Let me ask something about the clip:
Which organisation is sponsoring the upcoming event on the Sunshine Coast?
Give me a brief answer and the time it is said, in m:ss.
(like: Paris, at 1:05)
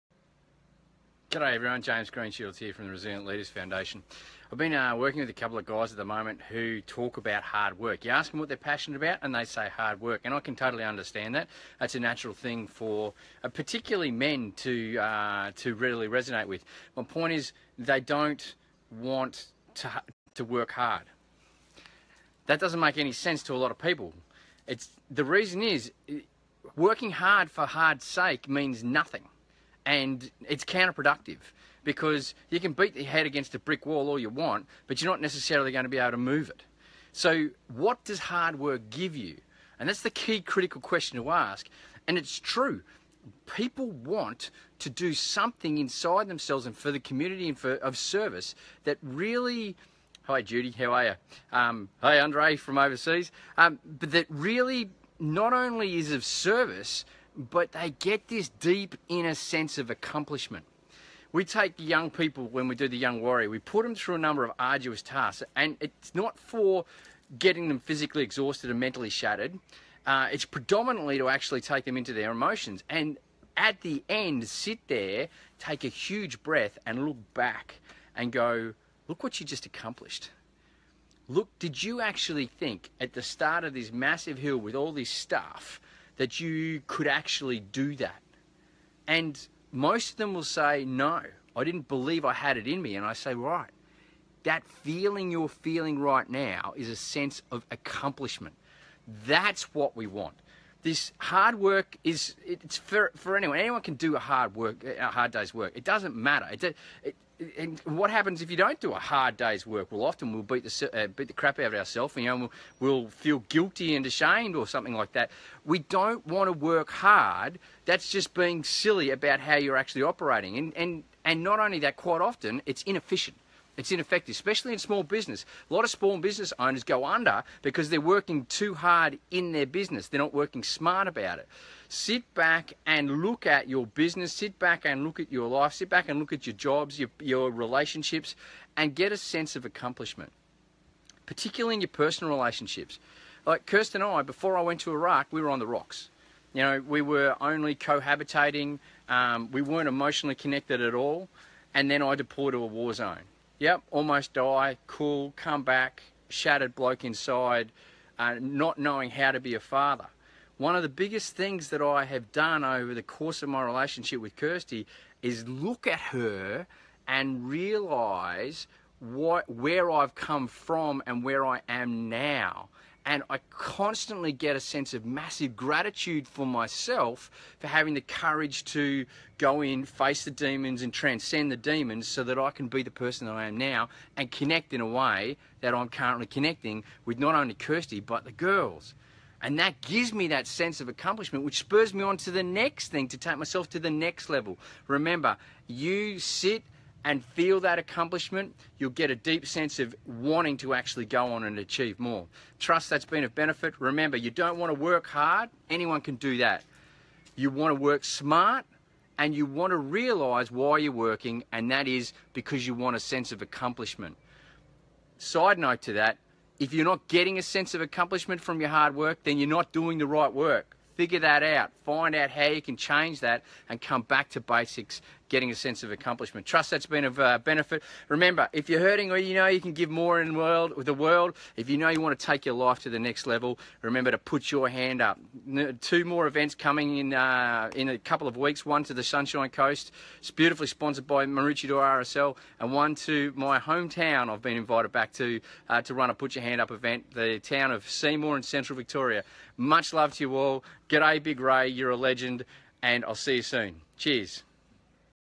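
Maroochydore RSL, at 4:01.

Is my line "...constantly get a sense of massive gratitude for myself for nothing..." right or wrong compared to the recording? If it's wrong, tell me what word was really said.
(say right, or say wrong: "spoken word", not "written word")
wrong: "having", not "nothing".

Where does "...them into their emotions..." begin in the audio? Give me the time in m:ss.
1:11.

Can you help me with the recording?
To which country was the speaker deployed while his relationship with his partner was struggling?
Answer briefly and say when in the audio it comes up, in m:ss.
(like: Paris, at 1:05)
Iraq, at 2:24.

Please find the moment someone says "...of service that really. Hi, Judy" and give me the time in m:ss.
0:47.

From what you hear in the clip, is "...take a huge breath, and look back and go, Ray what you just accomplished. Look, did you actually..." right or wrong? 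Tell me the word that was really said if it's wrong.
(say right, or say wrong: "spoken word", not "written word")
wrong: "Look", not "Ray".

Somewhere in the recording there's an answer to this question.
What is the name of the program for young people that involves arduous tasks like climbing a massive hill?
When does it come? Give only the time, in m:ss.
1:02.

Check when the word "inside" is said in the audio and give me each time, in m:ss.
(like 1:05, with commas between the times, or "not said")
0:45, 2:37.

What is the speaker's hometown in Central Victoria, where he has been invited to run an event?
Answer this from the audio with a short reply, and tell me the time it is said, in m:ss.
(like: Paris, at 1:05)
Seymour, at 4:07.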